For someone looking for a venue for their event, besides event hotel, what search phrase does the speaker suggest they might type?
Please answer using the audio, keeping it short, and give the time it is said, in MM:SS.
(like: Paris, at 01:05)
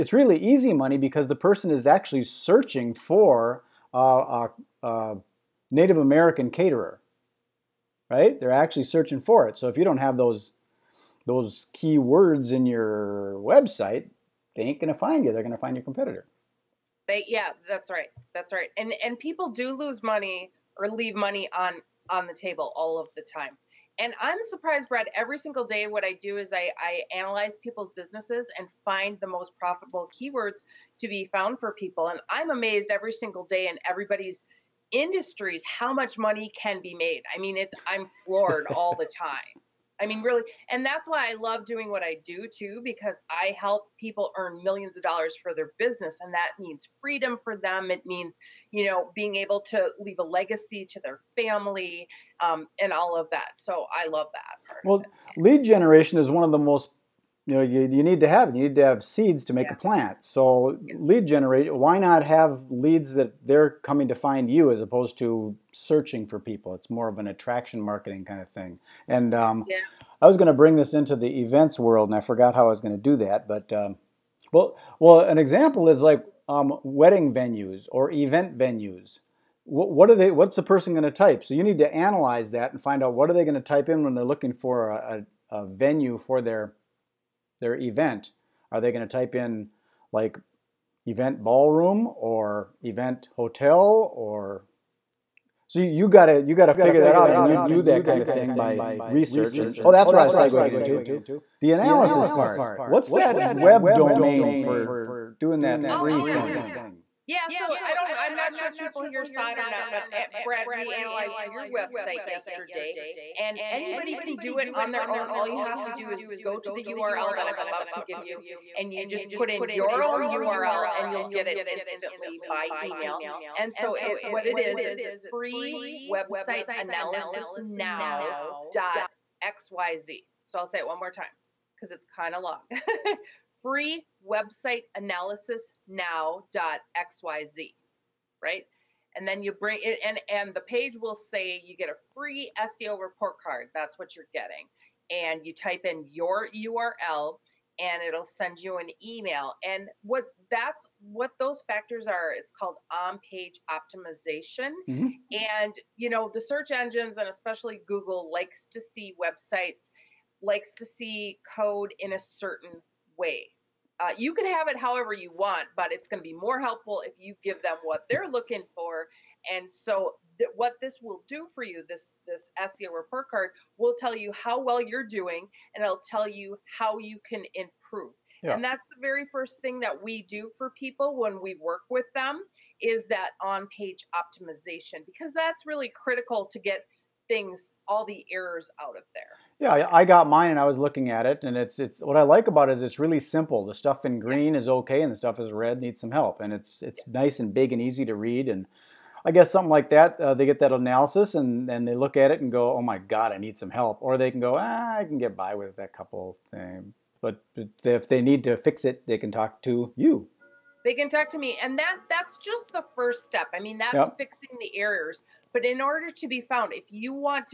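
event ballroom, at 01:31.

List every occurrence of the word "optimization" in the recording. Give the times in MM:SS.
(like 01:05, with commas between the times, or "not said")
02:33, 03:04.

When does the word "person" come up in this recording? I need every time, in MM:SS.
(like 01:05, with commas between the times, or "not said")
00:01, 01:20.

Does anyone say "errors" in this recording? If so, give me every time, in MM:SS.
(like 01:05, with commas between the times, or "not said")
03:08, 03:34.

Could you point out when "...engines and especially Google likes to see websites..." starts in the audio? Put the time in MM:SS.
02:36.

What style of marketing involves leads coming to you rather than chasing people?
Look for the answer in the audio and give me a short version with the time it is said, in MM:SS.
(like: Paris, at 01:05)
attraction marketing, at 01:07.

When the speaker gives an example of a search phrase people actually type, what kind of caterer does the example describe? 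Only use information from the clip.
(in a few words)
Native American caterer.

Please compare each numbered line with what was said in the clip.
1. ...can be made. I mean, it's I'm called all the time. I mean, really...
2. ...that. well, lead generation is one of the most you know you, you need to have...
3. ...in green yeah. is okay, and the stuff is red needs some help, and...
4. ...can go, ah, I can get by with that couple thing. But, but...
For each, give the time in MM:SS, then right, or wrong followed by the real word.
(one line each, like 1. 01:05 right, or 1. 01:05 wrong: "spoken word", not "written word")
1. 00:36 wrong: "floored", not "called"
2. 00:54 right
3. 03:14 right
4. 03:24 right.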